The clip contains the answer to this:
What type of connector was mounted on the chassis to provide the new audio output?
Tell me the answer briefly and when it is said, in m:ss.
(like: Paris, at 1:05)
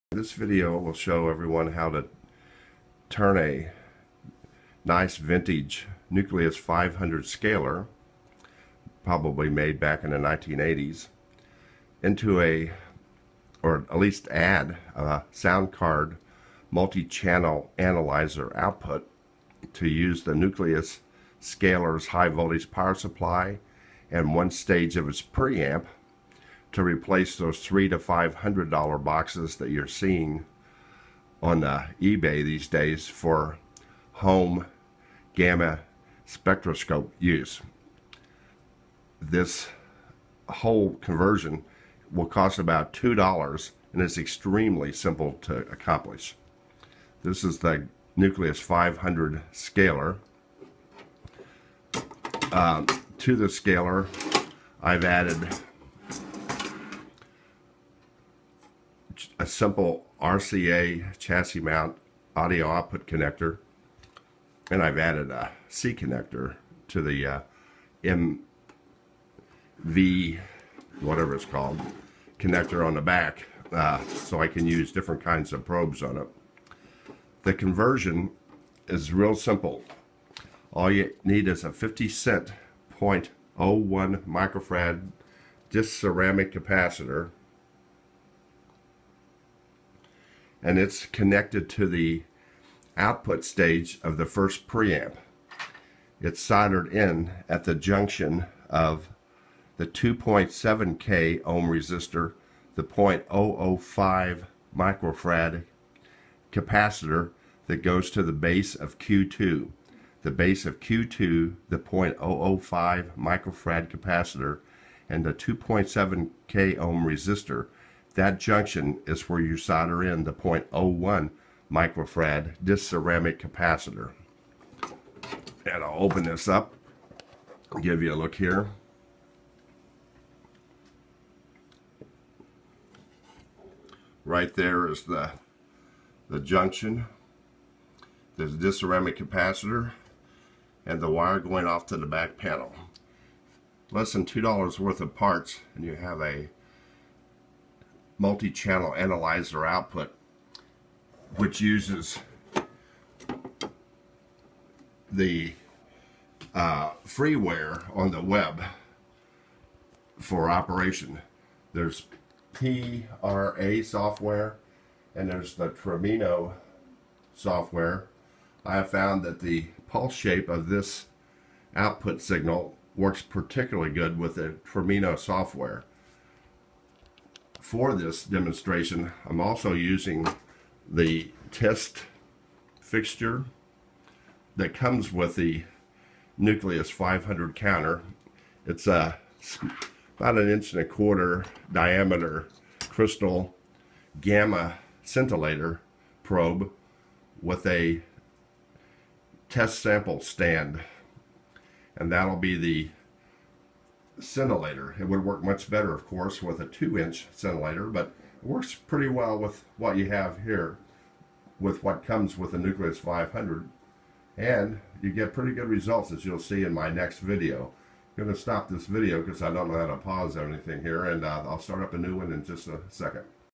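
RCA, at 1:00.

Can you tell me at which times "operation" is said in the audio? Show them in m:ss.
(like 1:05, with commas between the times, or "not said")
2:40.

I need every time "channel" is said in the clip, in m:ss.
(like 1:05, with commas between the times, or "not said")
0:16, 2:28.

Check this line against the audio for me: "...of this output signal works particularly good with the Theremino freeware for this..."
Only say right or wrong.
wrong.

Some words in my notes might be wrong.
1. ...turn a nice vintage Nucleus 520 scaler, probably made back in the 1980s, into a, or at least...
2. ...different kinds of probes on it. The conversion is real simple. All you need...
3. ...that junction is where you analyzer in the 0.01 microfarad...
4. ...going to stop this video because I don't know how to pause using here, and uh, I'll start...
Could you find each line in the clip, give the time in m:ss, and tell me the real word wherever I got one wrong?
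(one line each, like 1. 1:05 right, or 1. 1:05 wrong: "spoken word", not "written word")
1. 0:03 wrong: "500", not "520"
2. 1:14 right
3. 1:58 wrong: "solder", not "analyzer"
4. 3:38 wrong: "anything", not "using".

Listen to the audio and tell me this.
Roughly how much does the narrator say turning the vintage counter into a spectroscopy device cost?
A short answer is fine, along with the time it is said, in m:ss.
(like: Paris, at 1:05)
$2, at 0:42.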